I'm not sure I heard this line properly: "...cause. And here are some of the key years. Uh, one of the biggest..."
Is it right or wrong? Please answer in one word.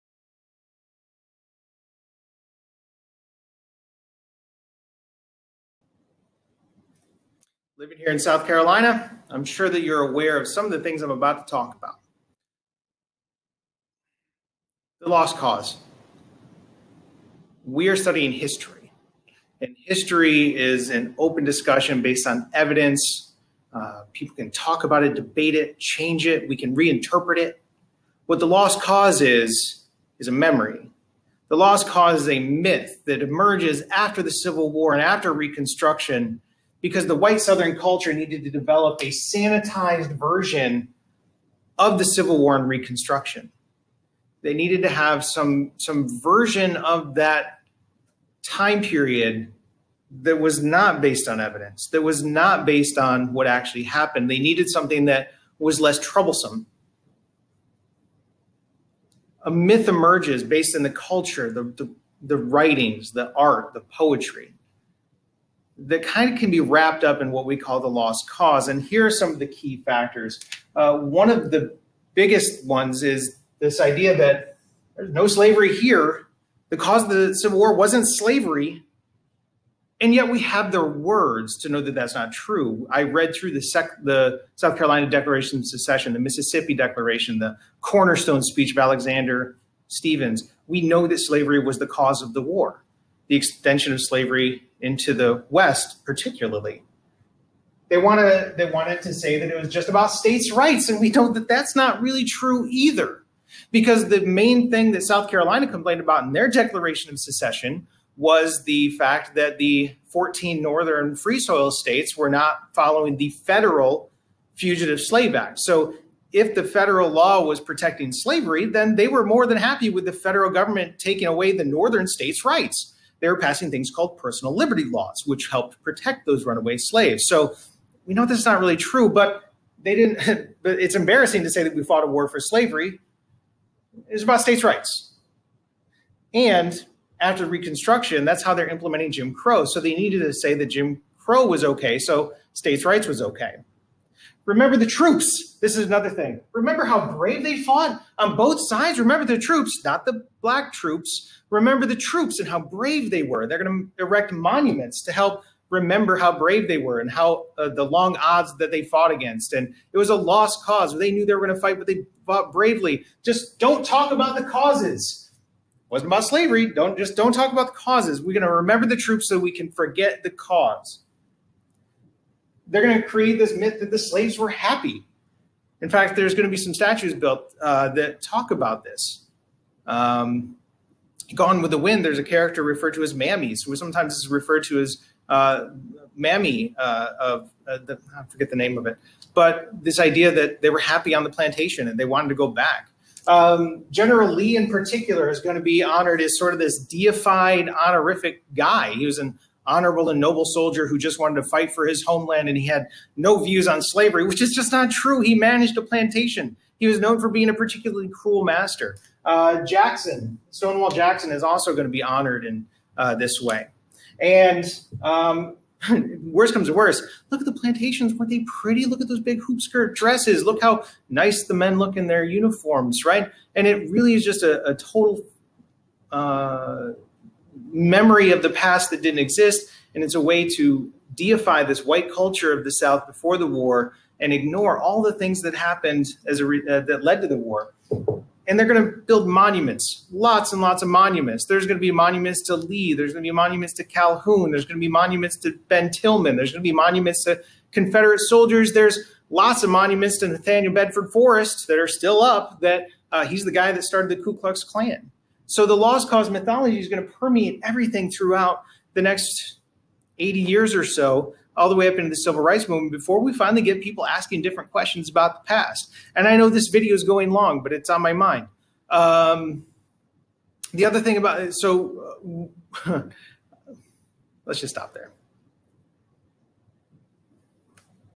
wrong.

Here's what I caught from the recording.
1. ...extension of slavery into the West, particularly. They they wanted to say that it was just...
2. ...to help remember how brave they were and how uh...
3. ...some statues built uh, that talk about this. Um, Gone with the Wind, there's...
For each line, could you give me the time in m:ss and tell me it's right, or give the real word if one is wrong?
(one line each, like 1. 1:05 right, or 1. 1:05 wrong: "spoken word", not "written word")
1. 1:33 right
2. 2:35 right
3. 2:56 right.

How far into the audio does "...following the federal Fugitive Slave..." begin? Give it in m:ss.
1:52.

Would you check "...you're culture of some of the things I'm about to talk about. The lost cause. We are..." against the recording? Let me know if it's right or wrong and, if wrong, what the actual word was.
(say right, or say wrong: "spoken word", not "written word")
wrong: "aware", not "culture".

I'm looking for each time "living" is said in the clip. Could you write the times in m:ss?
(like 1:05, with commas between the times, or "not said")
0:07.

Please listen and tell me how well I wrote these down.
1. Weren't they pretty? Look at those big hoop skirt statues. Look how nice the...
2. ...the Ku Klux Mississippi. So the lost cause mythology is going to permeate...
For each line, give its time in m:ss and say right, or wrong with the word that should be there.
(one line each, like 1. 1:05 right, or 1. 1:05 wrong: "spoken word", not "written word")
1. 3:38 wrong: "dresses", not "statues"
2. 4:14 wrong: "Klan", not "Mississippi".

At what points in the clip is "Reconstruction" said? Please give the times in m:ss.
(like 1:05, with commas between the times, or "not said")
0:35, 0:42, 2:17.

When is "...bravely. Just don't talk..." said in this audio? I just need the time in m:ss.
2:42.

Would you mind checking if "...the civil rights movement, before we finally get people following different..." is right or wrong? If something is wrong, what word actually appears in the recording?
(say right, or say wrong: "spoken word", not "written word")
wrong: "asking", not "following".